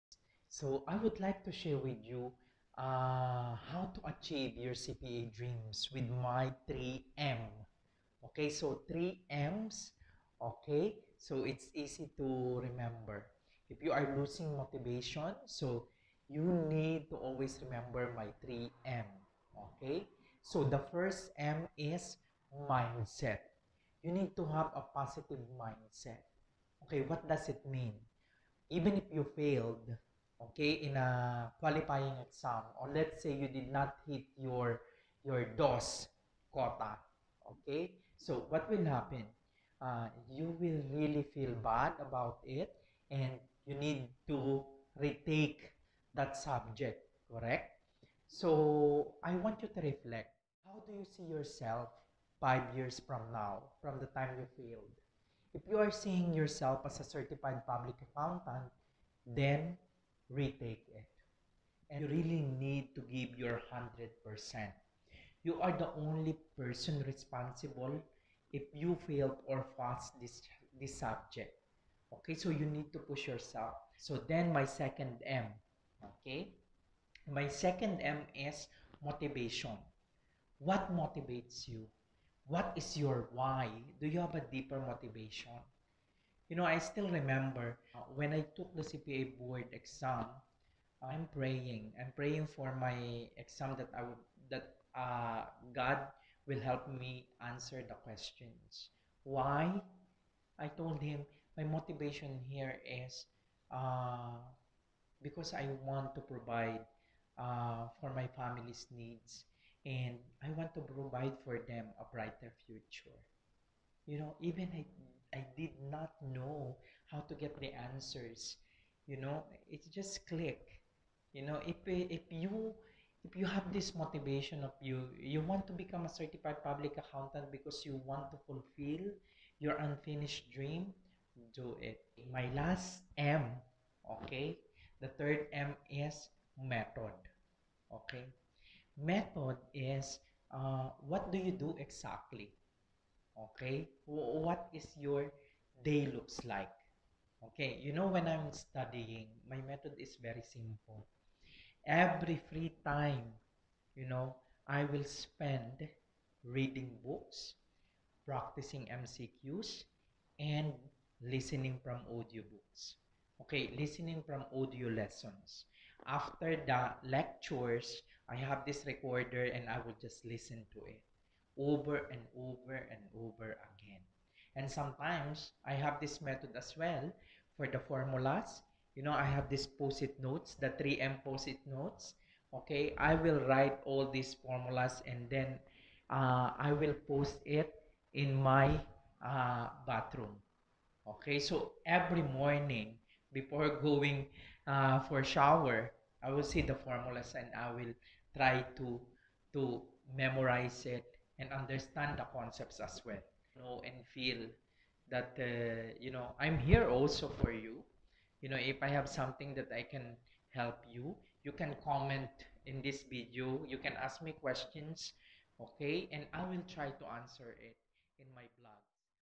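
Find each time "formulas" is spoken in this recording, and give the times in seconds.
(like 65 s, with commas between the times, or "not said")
177 s, 184 s, 196 s.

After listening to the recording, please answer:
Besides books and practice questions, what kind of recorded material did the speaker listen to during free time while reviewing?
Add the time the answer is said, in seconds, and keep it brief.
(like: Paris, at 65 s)
Audiobooks, at 162 s.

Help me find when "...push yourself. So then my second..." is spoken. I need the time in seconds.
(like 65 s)
72 s.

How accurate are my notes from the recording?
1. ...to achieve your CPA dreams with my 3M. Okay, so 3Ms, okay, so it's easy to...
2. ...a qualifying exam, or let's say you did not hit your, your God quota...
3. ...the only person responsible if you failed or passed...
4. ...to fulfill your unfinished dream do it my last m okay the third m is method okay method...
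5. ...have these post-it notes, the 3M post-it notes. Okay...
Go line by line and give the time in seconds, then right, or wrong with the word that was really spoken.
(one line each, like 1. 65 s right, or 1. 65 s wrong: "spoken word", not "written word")
1. 3 s right
2. 30 s wrong: "DOS", not "God"
3. 65 s right
4. 128 s right
5. 179 s right.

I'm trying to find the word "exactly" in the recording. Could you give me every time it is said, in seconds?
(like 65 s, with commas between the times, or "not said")
141 s.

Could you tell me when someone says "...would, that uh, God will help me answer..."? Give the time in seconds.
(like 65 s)
94 s.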